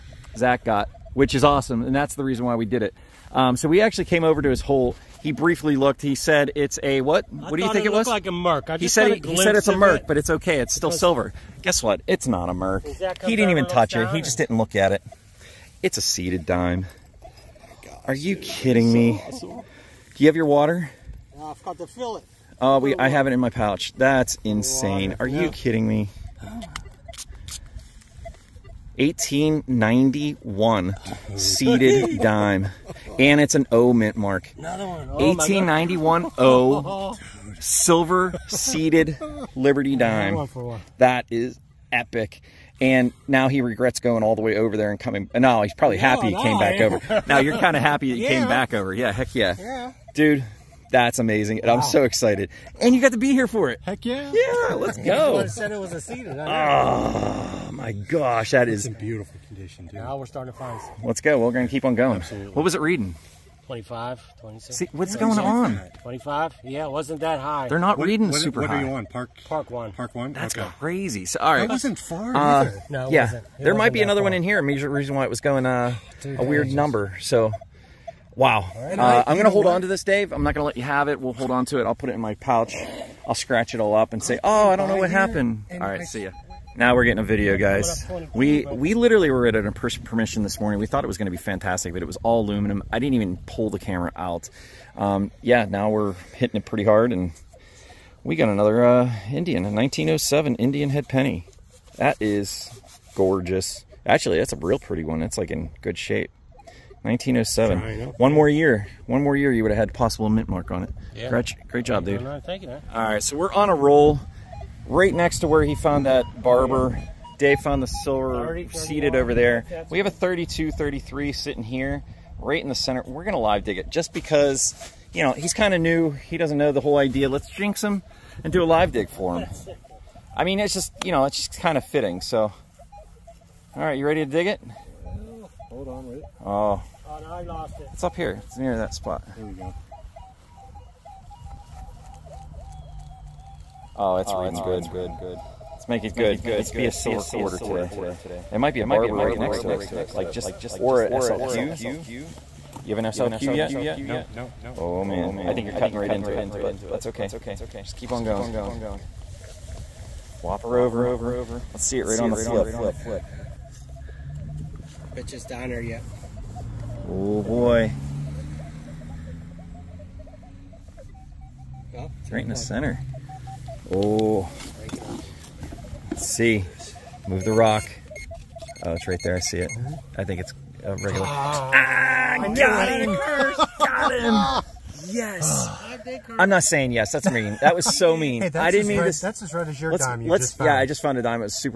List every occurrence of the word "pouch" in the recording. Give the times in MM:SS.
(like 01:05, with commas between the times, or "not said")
00:23, 01:22.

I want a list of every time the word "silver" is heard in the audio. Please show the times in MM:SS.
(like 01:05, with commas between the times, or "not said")
00:10, 00:37, 01:57, 02:26.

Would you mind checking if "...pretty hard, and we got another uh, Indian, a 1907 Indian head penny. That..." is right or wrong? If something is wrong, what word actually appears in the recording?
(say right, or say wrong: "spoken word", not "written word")
right.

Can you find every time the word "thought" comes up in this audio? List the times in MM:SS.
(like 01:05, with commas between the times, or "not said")
01:30.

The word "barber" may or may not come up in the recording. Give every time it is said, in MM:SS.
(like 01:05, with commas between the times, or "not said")
01:56, 02:28.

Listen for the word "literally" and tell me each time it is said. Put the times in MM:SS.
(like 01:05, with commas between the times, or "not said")
01:28.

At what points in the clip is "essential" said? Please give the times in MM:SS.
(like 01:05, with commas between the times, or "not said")
not said.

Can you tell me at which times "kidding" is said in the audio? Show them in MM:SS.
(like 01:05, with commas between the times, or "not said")
00:18, 00:25.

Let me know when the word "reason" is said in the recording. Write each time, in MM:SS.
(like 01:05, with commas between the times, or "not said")
00:02, 01:14.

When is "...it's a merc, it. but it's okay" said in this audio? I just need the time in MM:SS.
00:09.